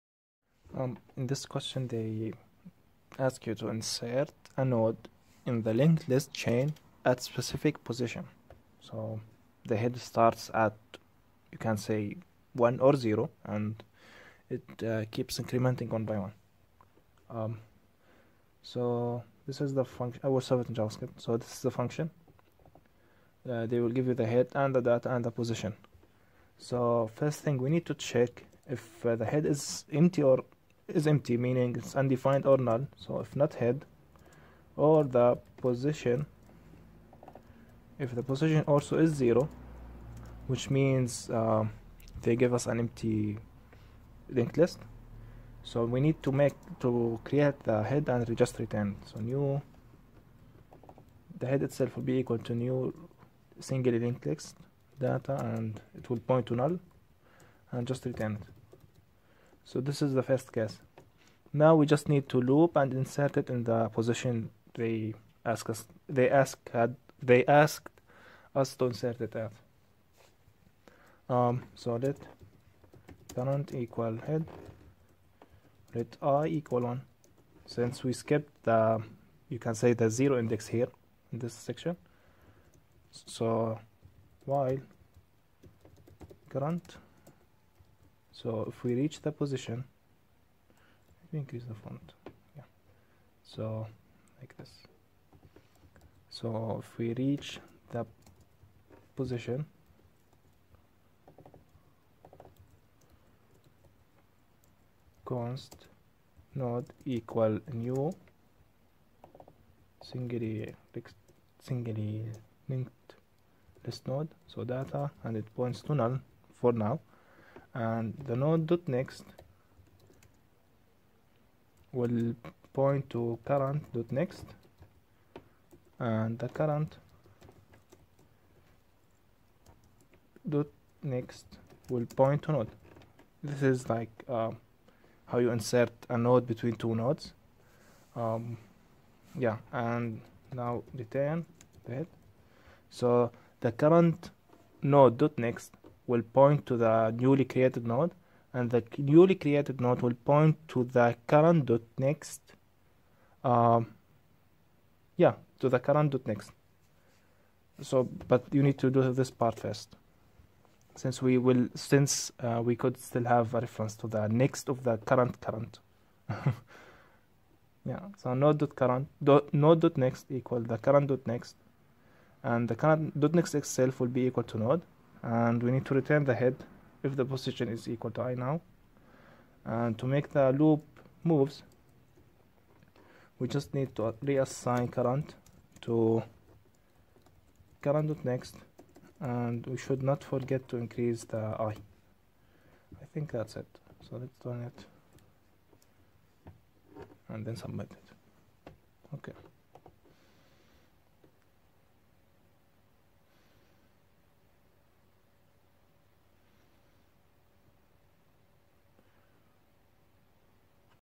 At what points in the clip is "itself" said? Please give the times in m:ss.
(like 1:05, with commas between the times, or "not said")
0:51, 2:53.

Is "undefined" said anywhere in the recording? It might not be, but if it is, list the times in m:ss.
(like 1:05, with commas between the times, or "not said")
0:31.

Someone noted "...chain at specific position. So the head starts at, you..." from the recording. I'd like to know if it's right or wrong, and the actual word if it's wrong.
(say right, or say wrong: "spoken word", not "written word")
right.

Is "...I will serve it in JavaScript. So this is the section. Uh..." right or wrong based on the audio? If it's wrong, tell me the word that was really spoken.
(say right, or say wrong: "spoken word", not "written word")
wrong: "function", not "section".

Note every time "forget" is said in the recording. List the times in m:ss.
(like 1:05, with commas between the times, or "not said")
3:10.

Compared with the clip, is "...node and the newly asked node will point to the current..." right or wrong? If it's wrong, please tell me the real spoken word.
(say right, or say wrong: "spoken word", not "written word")
wrong: "created", not "asked".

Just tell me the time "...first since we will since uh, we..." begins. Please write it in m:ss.
2:39.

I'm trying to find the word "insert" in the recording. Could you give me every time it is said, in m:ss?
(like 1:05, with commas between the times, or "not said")
0:03, 1:03, 1:08, 2:15.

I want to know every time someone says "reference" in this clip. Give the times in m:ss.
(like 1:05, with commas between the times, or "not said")
2:43.